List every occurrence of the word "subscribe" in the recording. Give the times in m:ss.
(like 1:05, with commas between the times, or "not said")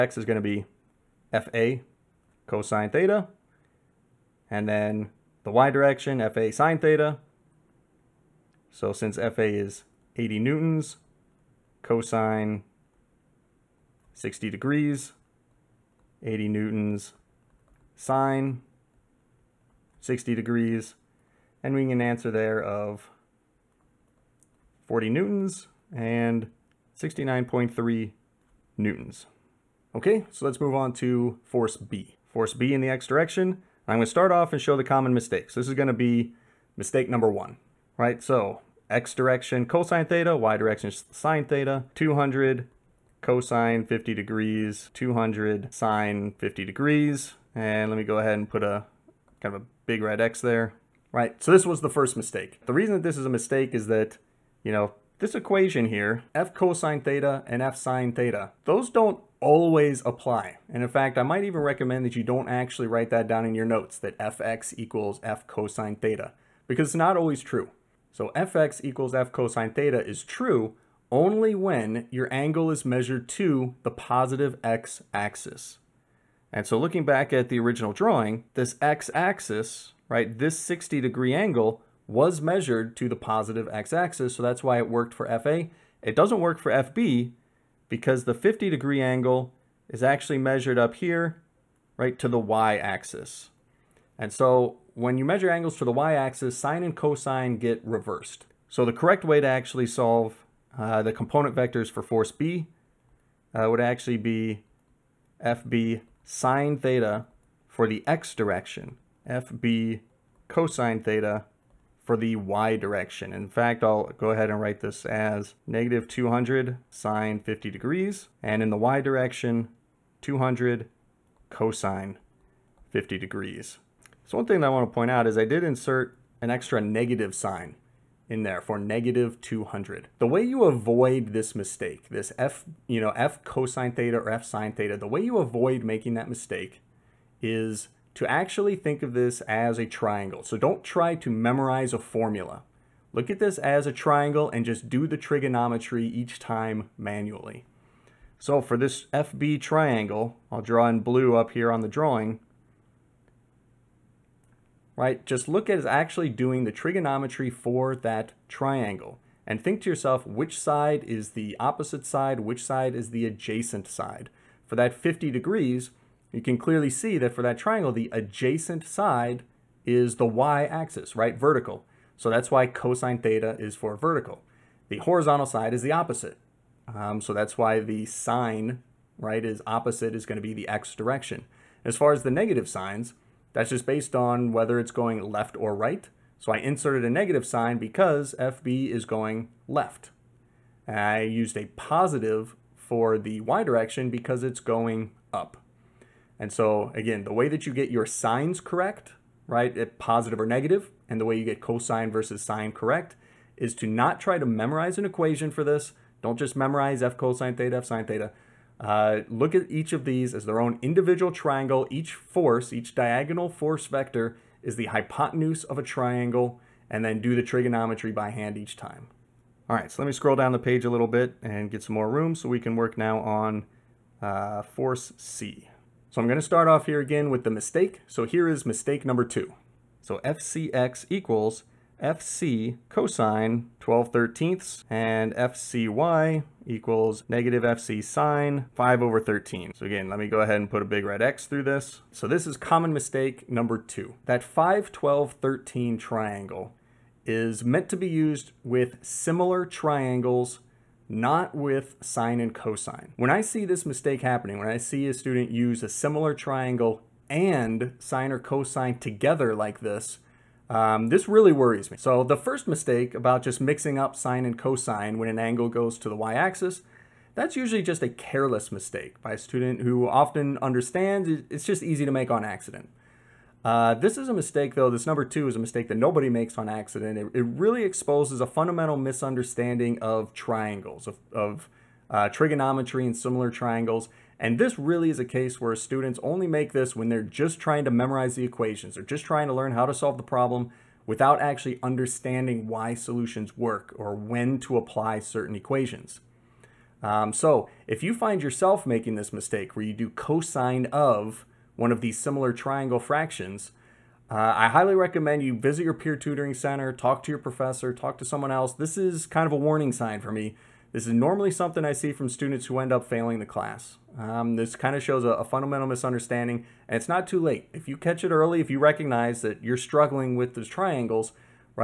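not said.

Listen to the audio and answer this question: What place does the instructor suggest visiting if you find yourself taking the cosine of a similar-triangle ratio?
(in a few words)
peer tutoring center.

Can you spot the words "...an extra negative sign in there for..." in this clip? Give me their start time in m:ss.
2:06.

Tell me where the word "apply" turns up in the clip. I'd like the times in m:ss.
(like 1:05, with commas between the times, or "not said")
1:00, 4:54.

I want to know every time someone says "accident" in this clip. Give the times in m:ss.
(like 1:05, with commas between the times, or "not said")
4:32, 4:36.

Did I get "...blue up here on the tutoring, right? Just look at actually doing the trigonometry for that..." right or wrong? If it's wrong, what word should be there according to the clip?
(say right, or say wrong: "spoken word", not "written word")
wrong: "drawing", not "tutoring".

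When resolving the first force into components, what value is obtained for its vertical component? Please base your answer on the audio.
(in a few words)
69.3 newtons.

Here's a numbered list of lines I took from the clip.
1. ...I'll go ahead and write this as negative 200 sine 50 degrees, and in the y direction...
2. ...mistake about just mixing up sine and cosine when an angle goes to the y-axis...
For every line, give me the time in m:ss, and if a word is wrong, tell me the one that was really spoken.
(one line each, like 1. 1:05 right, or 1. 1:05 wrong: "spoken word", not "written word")
1. 1:53 right
2. 4:22 right.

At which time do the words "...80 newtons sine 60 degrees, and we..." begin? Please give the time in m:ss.
0:16.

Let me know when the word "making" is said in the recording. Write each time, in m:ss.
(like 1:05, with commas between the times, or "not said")
2:15, 4:58.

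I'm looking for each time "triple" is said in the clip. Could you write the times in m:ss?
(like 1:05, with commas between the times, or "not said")
not said.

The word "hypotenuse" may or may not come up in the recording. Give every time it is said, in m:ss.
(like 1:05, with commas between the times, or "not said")
3:34.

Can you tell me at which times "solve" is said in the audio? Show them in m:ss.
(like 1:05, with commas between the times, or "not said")
1:39, 4:49.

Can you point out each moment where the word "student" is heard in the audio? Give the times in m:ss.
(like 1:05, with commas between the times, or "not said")
4:15, 4:29, 4:45, 5:12.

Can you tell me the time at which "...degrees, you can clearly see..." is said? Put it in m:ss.
2:45.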